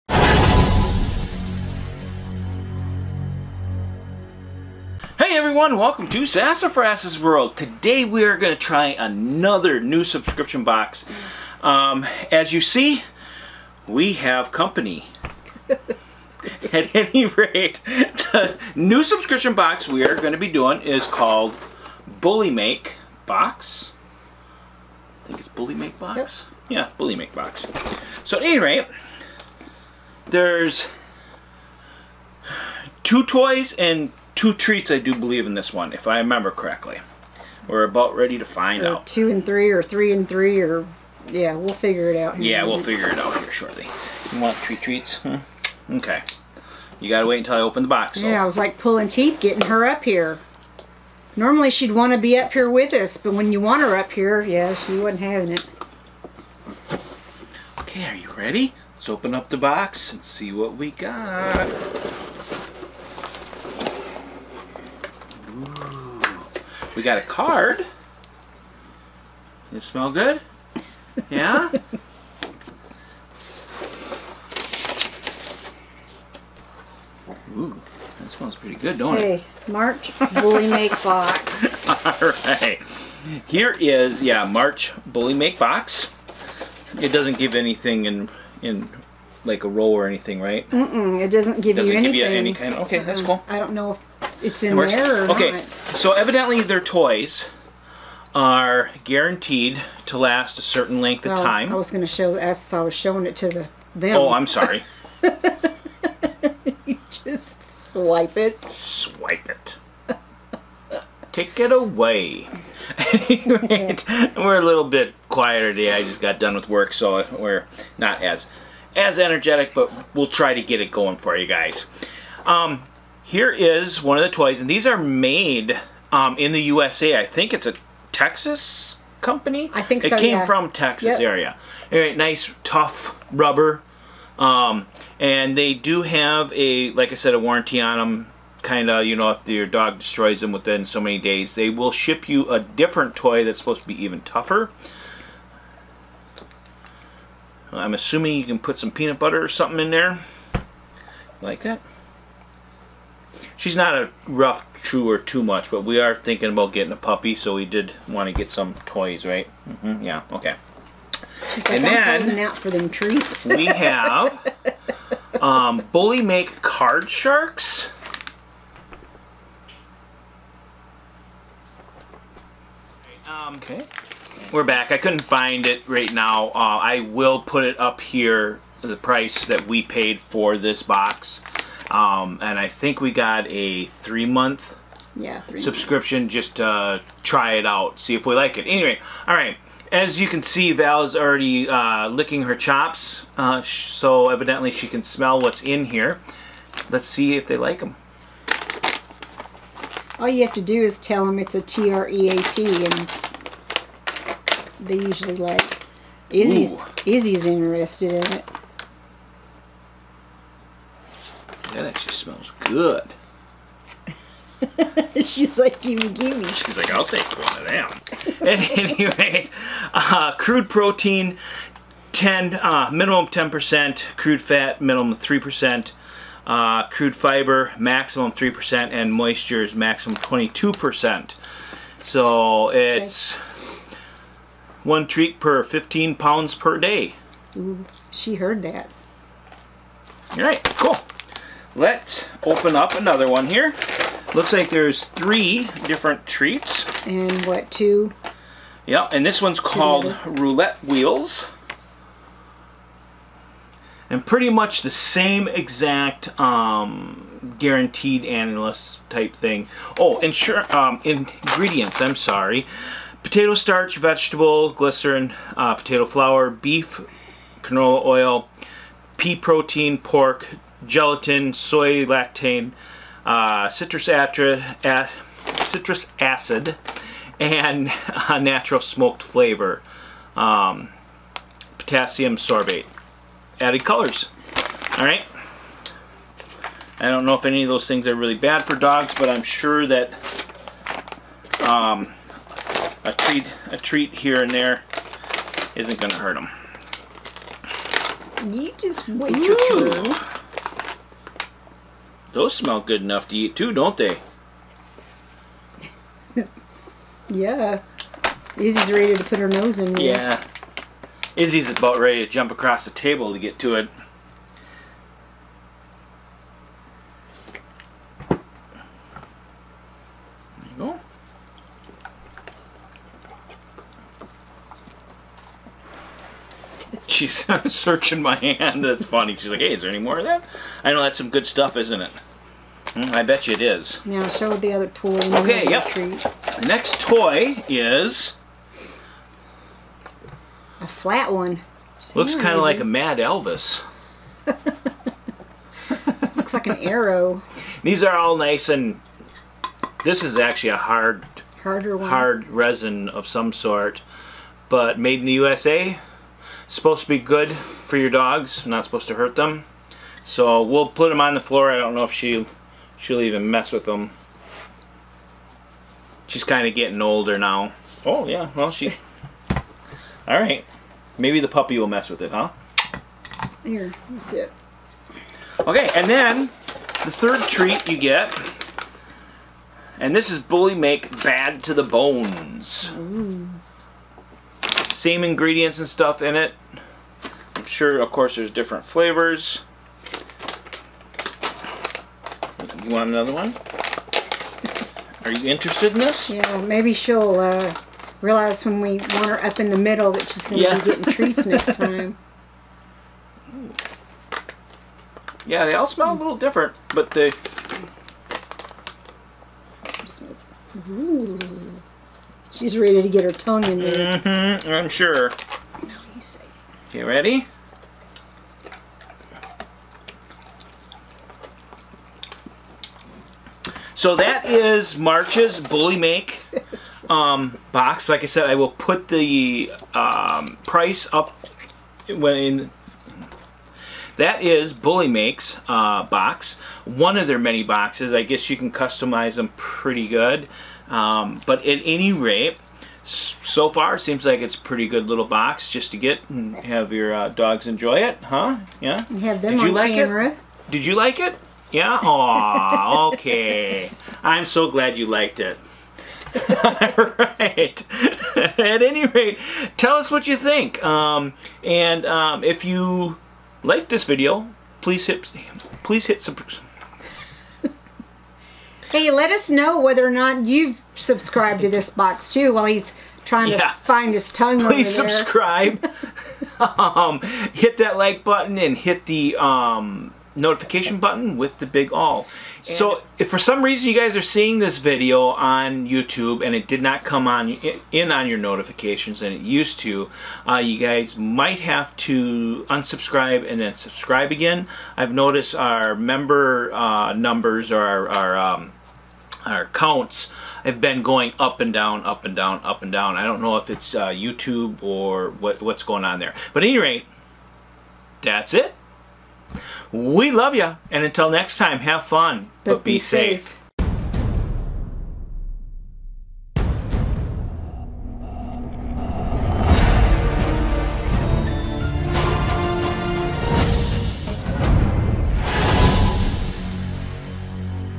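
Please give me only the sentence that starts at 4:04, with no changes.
Looks like there's three different treats.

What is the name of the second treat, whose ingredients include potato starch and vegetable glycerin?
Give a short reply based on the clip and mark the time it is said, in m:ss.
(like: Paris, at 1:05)
Roulette Wheels, at 4:10.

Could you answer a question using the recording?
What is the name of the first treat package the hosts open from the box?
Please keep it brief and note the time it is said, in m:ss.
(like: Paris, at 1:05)
Card Sharks, at 2:45.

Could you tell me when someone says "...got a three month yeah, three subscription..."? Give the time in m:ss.
3:03.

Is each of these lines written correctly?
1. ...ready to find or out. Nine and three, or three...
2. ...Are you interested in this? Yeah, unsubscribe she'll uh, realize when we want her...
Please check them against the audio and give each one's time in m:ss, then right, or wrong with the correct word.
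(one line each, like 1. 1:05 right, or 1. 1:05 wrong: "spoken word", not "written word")
1. 0:38 wrong: "Two", not "Nine"
2. 6:35 wrong: "maybe", not "unsubscribe".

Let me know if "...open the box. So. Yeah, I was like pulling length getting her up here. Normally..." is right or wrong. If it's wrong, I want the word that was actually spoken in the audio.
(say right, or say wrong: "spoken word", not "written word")
wrong: "teeth", not "length".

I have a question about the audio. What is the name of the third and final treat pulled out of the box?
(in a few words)
Bad to the Bones.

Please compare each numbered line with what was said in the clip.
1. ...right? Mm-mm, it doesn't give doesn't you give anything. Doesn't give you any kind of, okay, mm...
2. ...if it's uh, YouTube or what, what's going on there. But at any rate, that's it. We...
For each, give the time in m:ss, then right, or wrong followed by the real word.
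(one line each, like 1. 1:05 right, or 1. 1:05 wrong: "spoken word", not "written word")
1. 1:30 right
2. 8:23 right.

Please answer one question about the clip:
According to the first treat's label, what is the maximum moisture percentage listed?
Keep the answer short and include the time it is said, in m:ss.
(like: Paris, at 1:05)
22%, at 3:50.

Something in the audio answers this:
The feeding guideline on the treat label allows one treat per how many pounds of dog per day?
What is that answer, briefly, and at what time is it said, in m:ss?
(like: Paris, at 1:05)
15 pounds, at 3:55.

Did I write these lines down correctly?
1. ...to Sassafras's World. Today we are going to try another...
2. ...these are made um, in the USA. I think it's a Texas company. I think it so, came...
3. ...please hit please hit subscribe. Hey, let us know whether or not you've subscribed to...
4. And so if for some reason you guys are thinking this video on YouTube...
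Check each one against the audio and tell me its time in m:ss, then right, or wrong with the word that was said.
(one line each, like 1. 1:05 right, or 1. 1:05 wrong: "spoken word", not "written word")
1. 0:06 right
2. 2:04 right
3. 7:44 right
4. 8:02 wrong: "seeing", not "thinking".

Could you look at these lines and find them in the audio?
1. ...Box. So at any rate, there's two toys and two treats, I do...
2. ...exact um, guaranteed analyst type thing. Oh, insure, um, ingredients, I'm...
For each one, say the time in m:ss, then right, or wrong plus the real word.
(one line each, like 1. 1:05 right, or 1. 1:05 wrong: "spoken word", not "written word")
1. 0:27 right
2. 4:15 right.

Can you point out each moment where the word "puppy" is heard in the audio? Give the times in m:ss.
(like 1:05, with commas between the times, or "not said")
2:36, 6:11.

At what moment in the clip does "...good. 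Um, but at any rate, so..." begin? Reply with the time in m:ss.
7:20.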